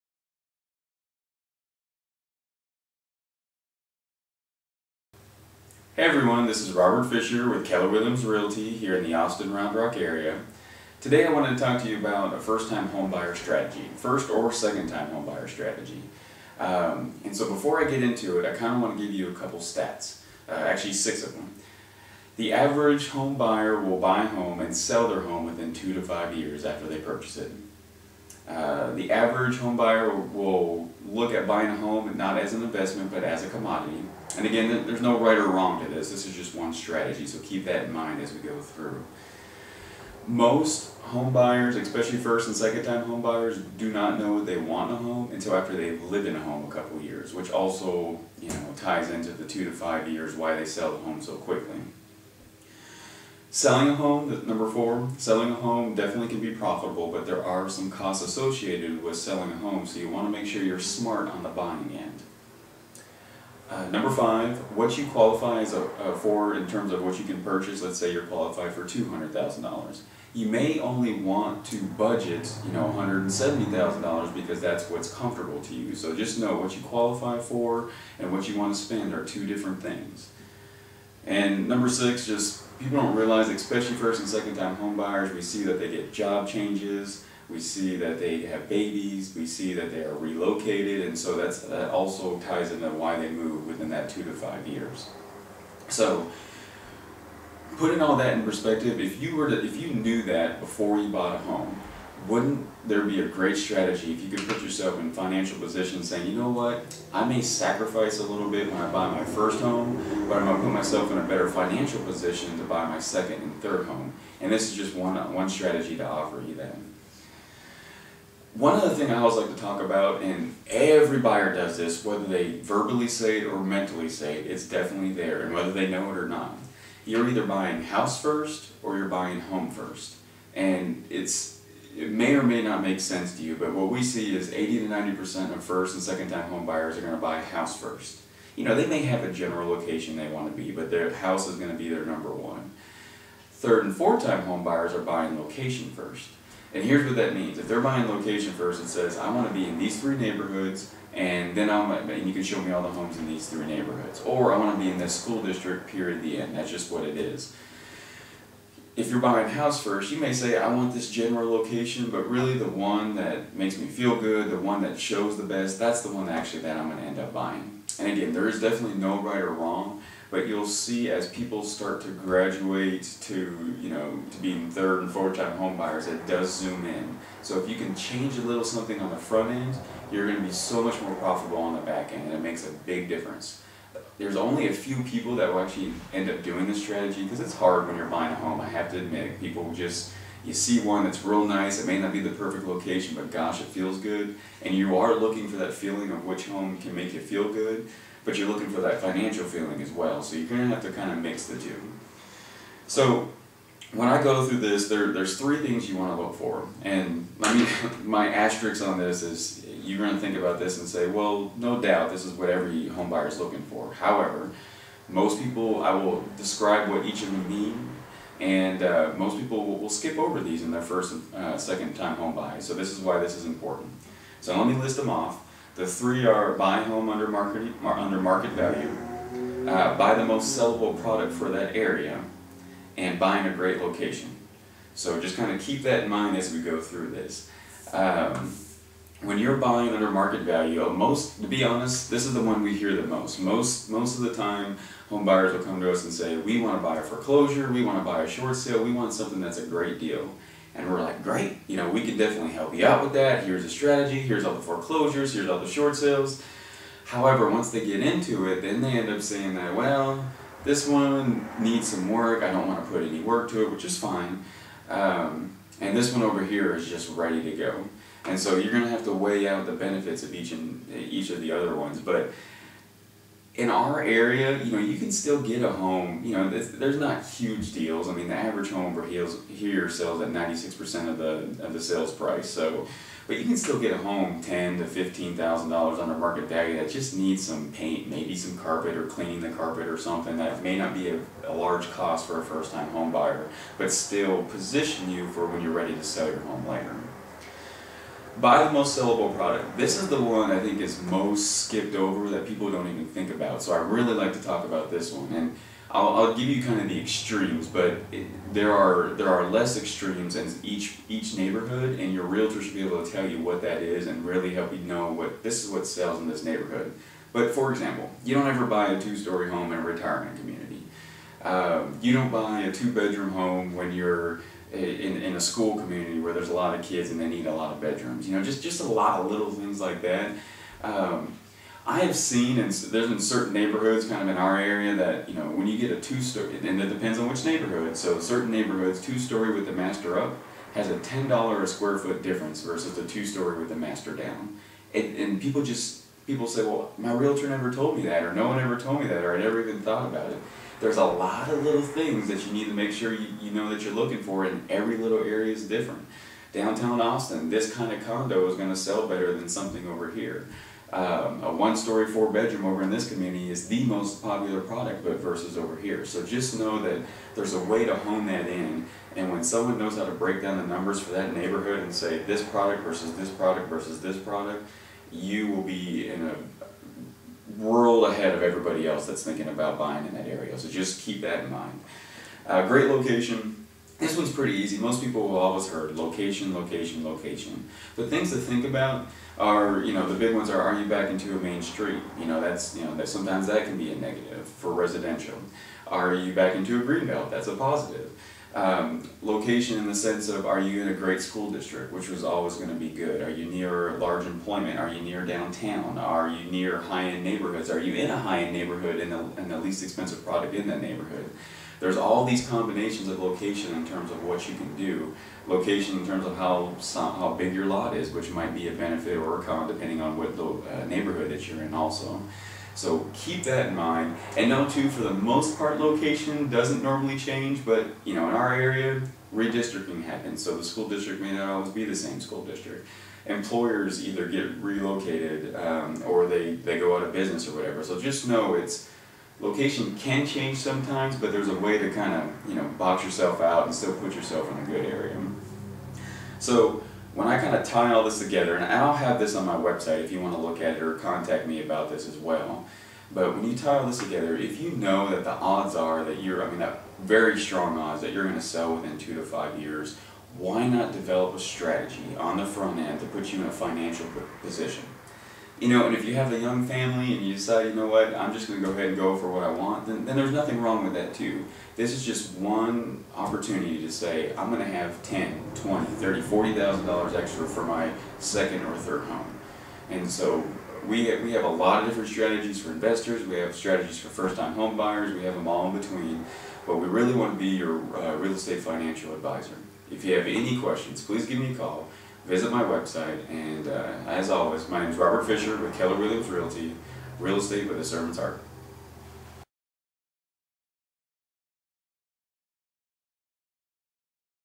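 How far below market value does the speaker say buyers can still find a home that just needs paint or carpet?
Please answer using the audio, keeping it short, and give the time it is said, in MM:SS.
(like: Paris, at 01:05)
$10,000 to $15,000, at 04:44.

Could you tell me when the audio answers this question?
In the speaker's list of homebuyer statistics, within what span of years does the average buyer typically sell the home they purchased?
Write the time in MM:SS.
00:25.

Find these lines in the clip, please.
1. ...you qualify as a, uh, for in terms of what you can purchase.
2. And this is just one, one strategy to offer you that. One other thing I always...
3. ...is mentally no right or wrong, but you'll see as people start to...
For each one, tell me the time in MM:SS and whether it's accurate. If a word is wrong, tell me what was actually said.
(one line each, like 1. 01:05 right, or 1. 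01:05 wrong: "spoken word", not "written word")
1. 01:04 right
2. 01:54 right
3. 02:48 wrong: "definitely", not "mentally".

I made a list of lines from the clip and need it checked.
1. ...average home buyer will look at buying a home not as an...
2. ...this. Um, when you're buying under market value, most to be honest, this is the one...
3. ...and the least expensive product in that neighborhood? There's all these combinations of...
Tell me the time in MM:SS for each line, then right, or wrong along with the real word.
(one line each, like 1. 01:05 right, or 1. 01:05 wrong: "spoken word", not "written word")
1. 00:29 right
2. 03:57 right
3. 06:49 right.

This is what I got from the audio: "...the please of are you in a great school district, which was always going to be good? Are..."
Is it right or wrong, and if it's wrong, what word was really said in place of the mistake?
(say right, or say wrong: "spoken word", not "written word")
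wrong: "sense", not "please".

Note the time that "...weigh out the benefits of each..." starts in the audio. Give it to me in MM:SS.
04:29.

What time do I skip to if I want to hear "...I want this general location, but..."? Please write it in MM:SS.
02:40.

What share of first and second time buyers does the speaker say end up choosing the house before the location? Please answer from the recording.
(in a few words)
80 to 90%.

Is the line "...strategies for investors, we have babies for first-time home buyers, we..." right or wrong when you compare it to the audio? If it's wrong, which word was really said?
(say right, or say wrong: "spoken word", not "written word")
wrong: "strategies", not "babies".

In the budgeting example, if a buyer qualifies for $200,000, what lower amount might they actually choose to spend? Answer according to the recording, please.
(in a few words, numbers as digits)
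$170,000.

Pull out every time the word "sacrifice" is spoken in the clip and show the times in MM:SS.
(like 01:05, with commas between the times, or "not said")
01:47.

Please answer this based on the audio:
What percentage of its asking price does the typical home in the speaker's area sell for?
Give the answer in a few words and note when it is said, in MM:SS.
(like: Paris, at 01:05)
96%, at 04:40.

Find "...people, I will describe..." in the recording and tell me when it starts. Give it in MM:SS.
03:35.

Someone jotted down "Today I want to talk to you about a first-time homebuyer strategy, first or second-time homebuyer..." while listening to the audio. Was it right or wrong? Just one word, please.
right.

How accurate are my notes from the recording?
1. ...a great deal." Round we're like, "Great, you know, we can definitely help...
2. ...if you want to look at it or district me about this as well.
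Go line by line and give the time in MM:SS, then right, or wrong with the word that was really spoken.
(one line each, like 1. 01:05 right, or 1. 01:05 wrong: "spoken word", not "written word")
1. 04:09 wrong: "And", not "Round"
2. 07:30 wrong: "contact", not "district".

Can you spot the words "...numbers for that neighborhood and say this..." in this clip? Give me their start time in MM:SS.
06:10.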